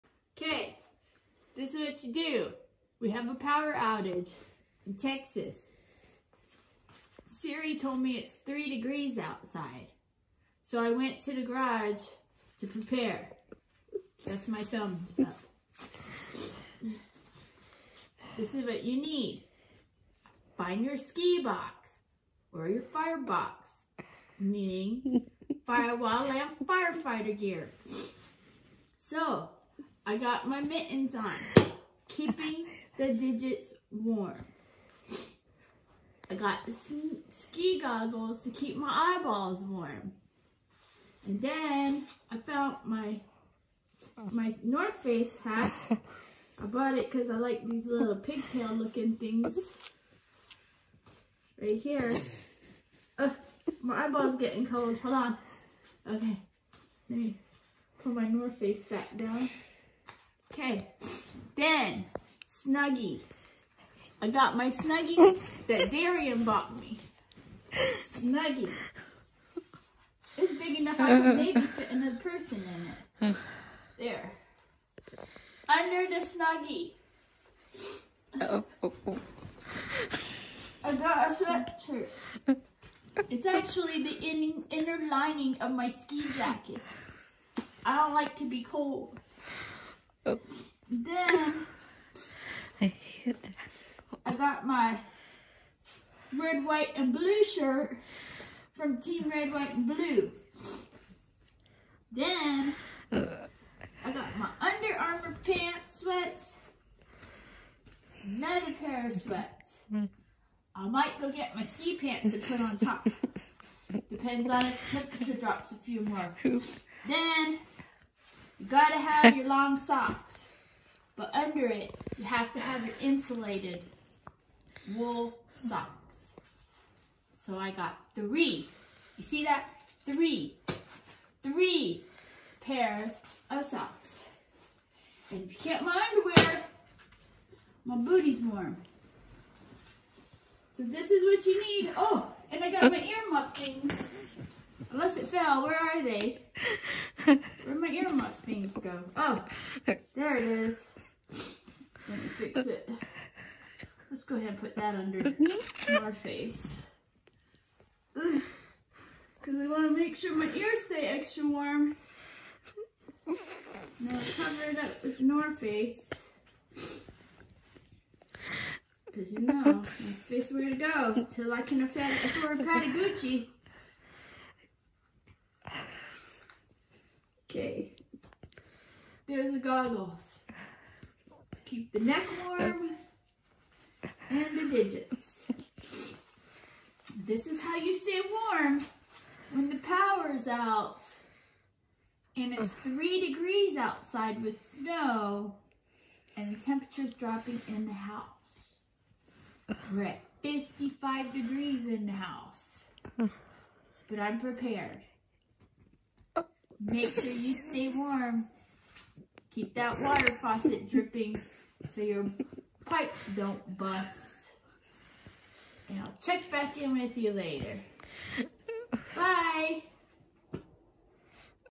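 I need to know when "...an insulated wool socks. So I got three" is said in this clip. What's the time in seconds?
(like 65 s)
122 s.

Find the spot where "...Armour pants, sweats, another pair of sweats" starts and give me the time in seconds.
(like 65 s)
104 s.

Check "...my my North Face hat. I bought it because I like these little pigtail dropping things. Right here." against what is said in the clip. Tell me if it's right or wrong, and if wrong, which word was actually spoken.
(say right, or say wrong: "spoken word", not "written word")
wrong: "looking", not "dropping".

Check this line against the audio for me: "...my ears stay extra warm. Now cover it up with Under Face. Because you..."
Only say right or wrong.
wrong.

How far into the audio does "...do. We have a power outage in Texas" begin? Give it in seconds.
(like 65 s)
2 s.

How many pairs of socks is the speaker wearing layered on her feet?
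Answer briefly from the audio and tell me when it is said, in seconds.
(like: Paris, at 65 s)
3, at 131 s.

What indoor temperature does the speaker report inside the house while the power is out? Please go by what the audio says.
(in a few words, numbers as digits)
55 degrees.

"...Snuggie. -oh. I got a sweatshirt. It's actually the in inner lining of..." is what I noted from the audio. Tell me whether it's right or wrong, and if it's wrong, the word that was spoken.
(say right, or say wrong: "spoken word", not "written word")
right.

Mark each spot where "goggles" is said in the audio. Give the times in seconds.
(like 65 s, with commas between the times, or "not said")
37 s, 179 s.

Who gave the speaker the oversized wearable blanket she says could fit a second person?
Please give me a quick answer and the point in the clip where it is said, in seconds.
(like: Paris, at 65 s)
Darian, at 65 s.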